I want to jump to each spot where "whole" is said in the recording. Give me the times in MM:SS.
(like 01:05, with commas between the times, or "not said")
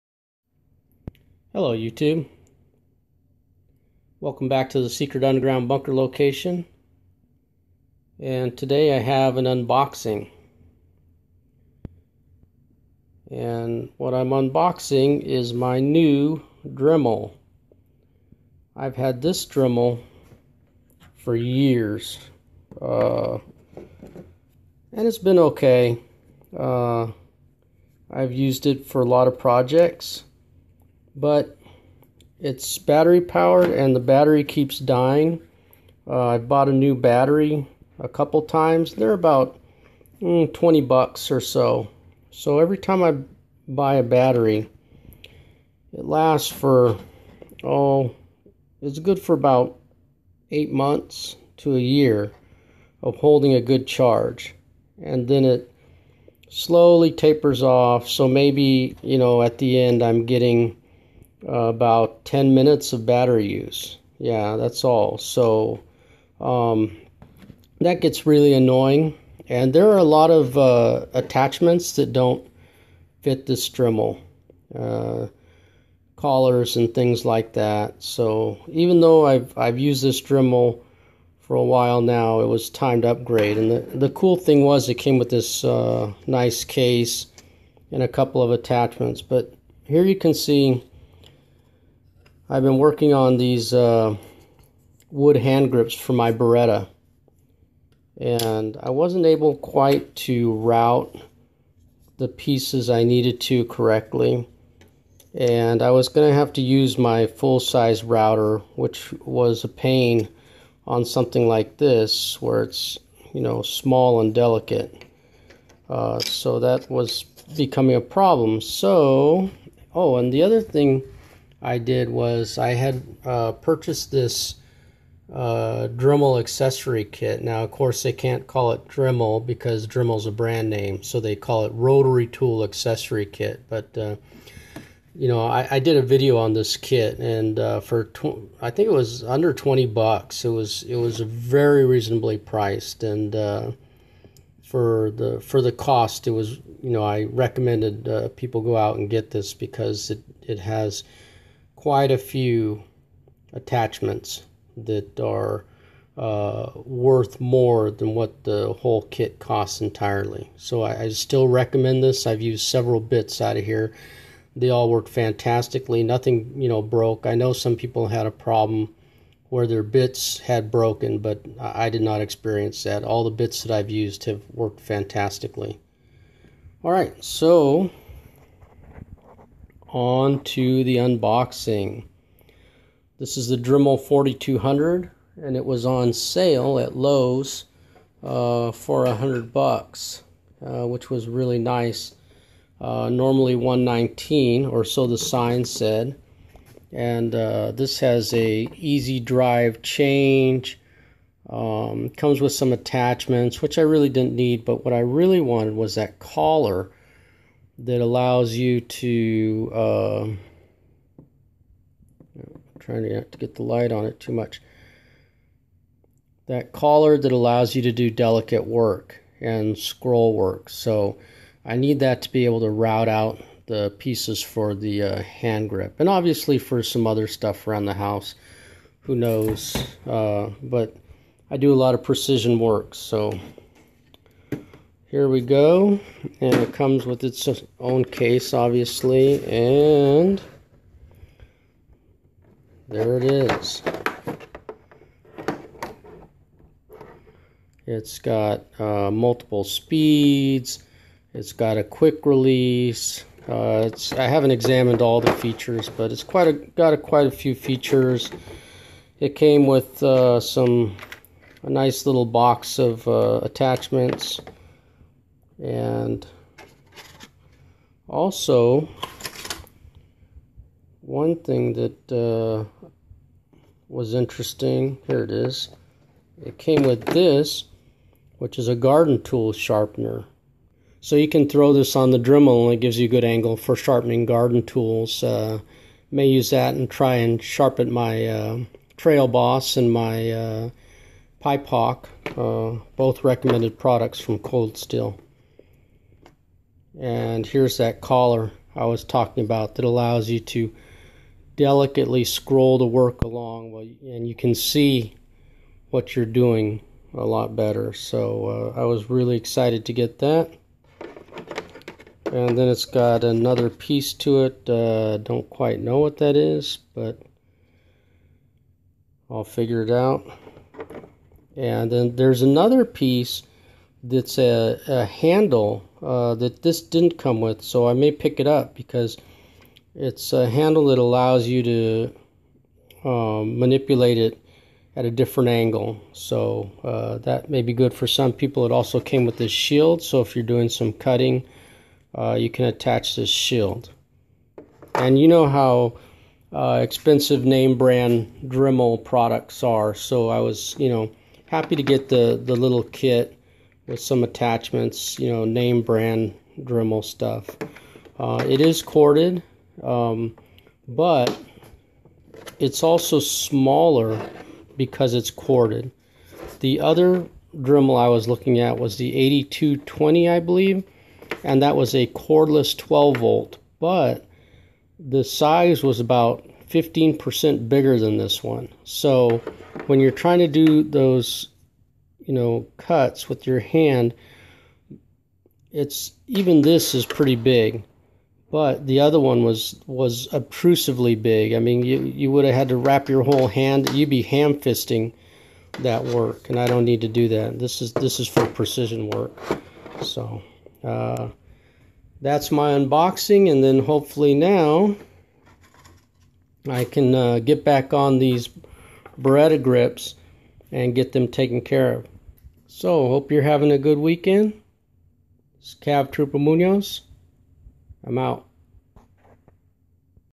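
02:38, 06:33.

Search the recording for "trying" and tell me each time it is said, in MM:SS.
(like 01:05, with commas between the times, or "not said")
03:32, 06:20.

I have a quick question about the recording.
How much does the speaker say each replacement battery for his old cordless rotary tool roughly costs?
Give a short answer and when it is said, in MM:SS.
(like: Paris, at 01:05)
$20, at 00:40.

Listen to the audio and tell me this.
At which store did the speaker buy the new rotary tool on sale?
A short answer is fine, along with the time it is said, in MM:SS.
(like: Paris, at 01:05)
Lowe's, at 03:06.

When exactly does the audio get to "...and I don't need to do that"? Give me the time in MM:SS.
06:36.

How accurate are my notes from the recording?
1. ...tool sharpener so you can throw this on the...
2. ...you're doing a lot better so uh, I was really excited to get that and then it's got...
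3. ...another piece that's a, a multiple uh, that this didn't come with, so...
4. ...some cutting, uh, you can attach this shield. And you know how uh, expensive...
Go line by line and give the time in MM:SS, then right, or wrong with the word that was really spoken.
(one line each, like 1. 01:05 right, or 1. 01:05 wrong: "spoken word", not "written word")
1. 04:39 right
2. 05:06 right
3. 05:22 wrong: "handle", not "multiple"
4. 05:40 right.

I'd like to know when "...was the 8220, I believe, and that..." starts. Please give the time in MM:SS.
06:08.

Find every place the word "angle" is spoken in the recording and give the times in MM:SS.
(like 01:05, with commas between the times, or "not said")
04:43, 05:35.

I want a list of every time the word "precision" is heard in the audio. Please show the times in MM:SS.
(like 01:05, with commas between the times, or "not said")
03:52, 06:38.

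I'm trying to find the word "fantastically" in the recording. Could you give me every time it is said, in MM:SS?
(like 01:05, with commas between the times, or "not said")
02:45, 02:54.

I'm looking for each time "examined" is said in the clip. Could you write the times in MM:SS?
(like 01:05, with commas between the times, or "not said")
04:14.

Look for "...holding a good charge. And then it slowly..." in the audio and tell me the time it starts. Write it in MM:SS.
00:53.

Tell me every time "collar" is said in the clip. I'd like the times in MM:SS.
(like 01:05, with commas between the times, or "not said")
01:16, 03:26, 03:36, 04:58.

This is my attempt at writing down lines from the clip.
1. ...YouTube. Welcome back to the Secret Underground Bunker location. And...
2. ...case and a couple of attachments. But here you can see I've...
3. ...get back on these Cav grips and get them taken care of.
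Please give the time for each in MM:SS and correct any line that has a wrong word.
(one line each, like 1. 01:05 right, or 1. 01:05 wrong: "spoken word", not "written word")
1. 00:01 right
2. 01:26 right
3. 06:47 wrong: "Beretta", not "Cav".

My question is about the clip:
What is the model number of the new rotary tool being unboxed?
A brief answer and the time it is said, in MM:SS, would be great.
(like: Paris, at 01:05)
4200, at 03:03.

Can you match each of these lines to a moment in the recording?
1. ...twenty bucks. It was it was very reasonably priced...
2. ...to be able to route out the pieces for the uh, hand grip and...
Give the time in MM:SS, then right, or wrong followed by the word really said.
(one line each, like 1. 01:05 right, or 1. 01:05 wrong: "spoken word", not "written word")
1. 02:19 right
2. 03:42 right.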